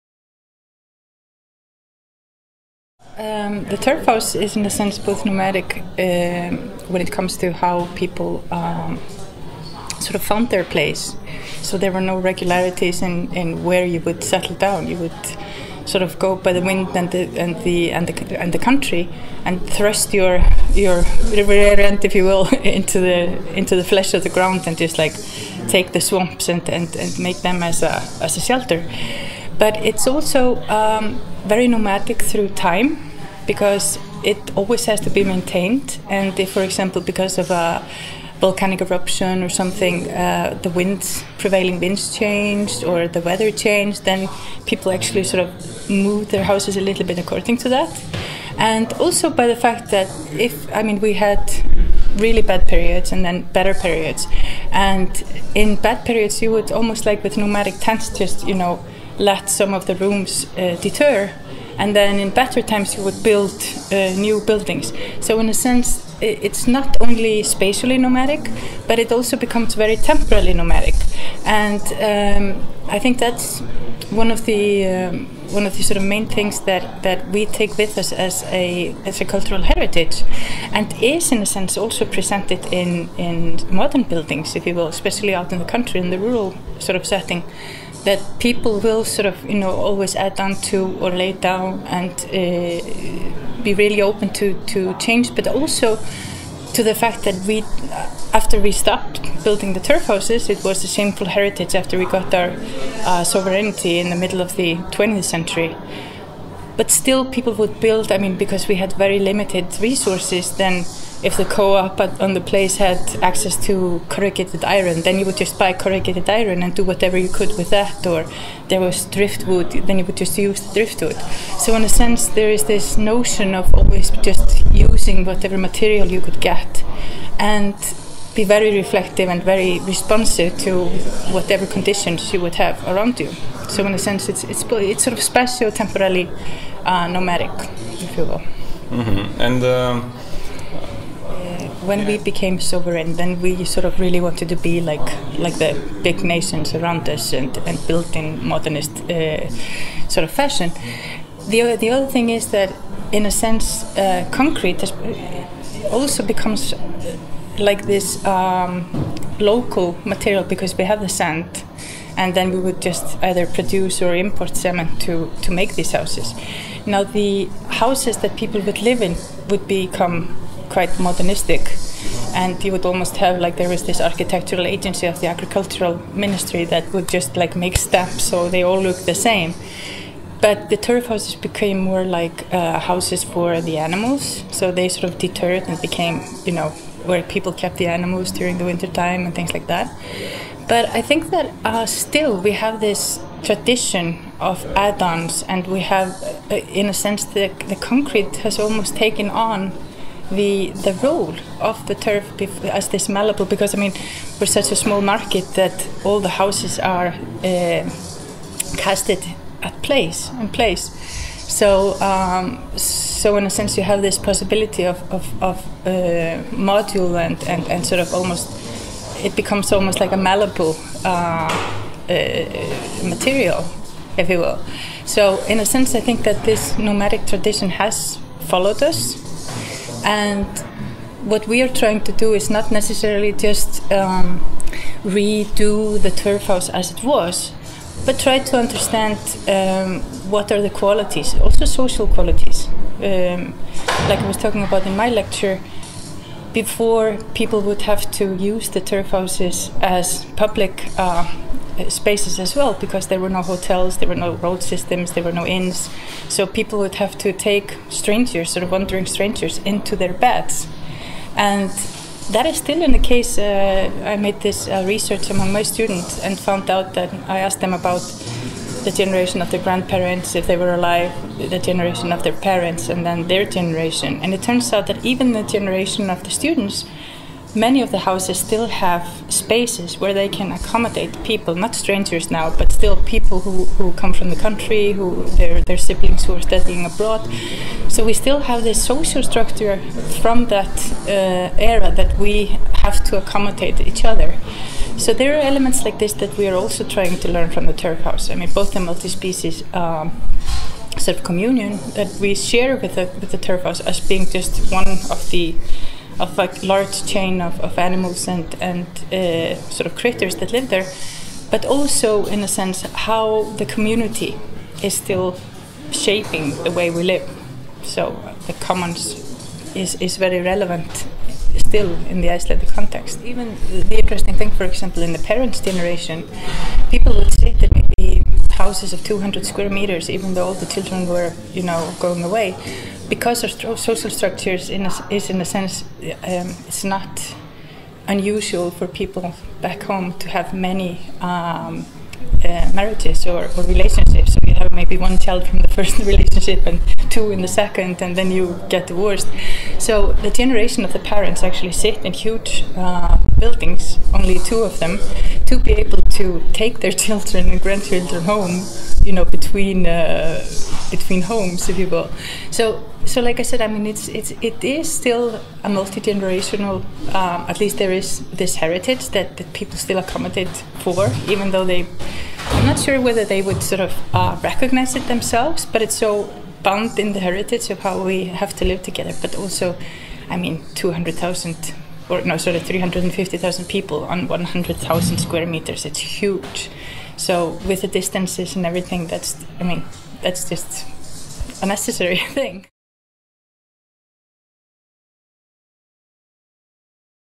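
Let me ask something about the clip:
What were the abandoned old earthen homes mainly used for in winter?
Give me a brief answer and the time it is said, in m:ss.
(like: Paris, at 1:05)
houses for the animals, at 3:02.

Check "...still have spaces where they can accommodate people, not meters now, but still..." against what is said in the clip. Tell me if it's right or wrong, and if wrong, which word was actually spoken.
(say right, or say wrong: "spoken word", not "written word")
wrong: "strangers", not "meters".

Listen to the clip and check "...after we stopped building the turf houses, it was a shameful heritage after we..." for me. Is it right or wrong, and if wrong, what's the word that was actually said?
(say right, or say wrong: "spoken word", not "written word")
right.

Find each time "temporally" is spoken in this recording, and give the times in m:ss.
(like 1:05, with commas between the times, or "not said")
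1:09, 2:15.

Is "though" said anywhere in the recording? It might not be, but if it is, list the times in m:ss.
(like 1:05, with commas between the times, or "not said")
5:30, 6:11.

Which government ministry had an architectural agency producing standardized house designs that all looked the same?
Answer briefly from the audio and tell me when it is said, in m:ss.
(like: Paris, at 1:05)
agricultural ministry, at 2:55.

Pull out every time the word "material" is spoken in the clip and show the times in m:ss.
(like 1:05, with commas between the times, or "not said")
2:05, 2:40, 3:43.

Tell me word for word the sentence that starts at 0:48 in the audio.
And also by the fact that if, I mean, we had really bad periods and then better periods.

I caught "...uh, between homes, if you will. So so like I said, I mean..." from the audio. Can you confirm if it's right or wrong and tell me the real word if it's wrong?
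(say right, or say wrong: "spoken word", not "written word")
right.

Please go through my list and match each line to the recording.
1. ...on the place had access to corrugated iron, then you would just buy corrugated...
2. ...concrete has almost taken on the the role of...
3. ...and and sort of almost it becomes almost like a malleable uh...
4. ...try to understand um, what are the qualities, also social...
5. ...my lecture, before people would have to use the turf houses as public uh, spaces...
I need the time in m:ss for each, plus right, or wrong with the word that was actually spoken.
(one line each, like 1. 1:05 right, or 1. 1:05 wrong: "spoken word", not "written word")
1. 1:52 right
2. 3:17 right
3. 3:37 right
4. 3:58 right
5. 4:04 right.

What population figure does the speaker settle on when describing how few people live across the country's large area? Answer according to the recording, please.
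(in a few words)
350,000.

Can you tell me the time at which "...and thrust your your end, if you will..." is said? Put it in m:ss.
0:19.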